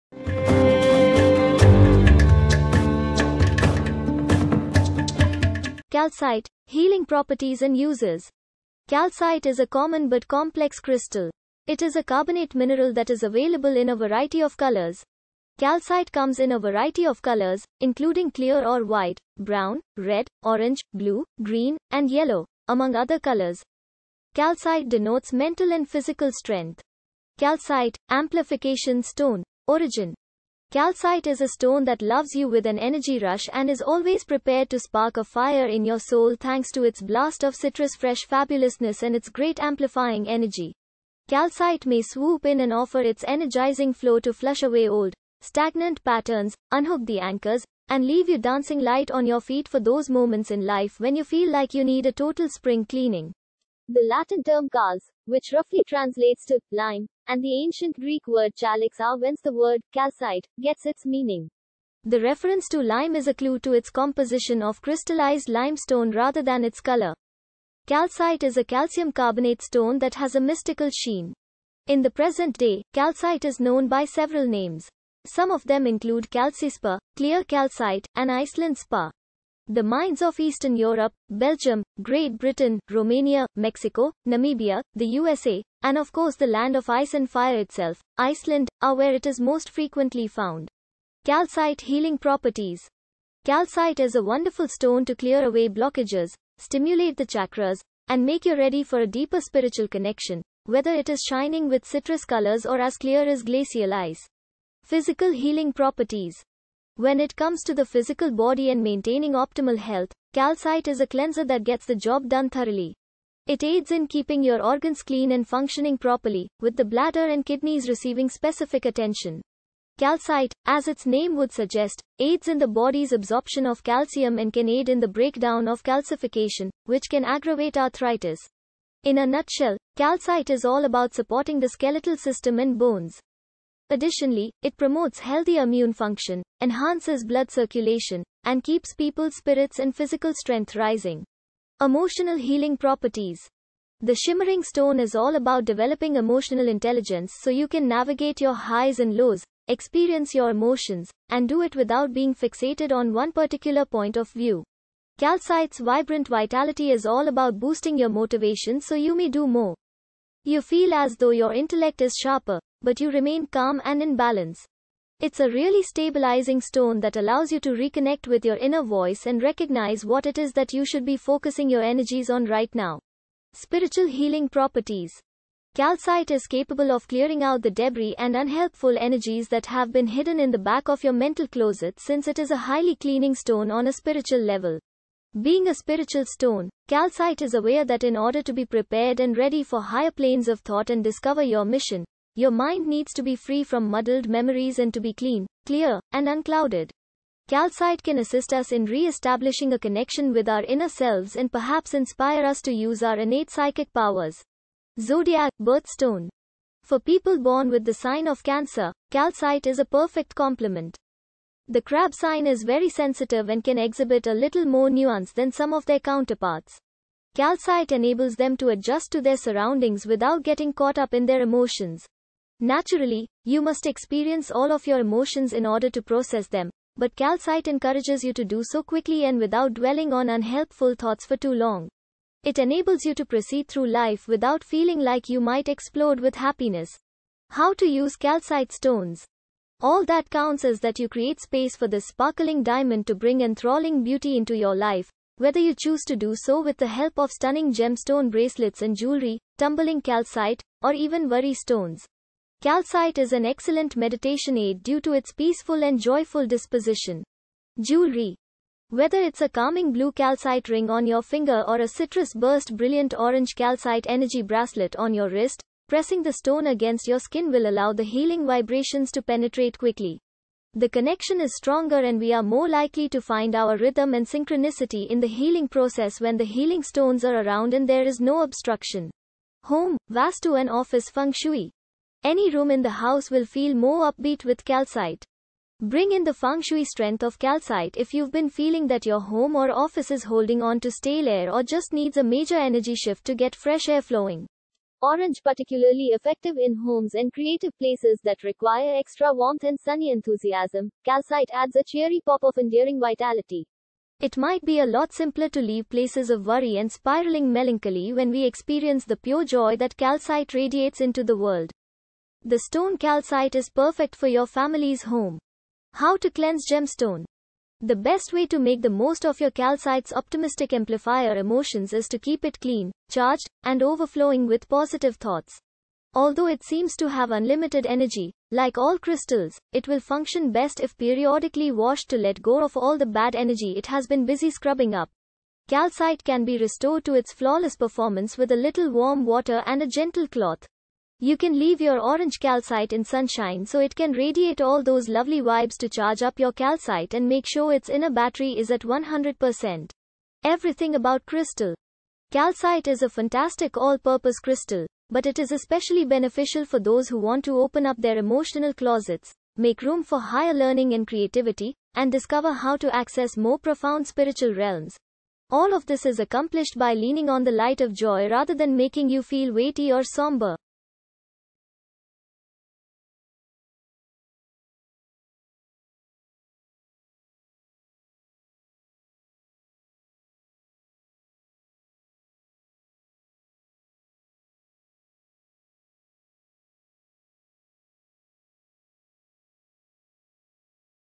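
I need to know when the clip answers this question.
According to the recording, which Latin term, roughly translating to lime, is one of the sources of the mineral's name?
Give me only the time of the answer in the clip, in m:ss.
0:54.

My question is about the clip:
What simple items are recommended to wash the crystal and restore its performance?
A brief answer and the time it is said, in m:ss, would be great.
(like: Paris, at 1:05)
warm water and a gentle cloth, at 5:38.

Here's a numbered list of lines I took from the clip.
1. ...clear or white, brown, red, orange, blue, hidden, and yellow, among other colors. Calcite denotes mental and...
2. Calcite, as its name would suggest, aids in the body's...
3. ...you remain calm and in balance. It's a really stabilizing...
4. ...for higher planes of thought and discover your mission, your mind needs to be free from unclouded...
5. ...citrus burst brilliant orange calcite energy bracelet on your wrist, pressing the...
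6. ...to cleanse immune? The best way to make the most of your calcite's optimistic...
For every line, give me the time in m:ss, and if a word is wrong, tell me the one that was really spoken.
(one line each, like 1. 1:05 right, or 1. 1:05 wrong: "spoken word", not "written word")
1. 0:18 wrong: "green", not "hidden"
2. 1:59 right
3. 2:42 right
4. 3:09 wrong: "muddled", not "unclouded"
5. 4:21 right
6. 5:16 wrong: "gemstone", not "immune".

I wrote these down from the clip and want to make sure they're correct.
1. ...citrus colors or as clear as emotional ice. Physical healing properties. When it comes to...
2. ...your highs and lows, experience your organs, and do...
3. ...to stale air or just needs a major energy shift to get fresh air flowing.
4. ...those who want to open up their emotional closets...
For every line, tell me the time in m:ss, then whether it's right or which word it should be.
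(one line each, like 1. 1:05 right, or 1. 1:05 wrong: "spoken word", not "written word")
1. 1:41 wrong: "glacial", not "emotional"
2. 2:28 wrong: "emotions", not "organs"
3. 4:50 right
4. 5:56 right.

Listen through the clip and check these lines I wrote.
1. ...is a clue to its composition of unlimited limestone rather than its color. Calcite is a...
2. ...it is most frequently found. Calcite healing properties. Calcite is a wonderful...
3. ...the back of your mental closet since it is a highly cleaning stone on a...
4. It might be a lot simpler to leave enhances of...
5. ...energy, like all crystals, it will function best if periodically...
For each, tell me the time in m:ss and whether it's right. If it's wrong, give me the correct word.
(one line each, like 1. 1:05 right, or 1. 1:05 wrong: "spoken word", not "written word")
1. 1:03 wrong: "crystallized", not "unlimited"
2. 1:29 right
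3. 3:00 right
4. 5:04 wrong: "places", not "enhances"
5. 5:27 right.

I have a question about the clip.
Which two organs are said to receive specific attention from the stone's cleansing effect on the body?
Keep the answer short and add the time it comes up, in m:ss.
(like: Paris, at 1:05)
bladder and kidneys, at 1:56.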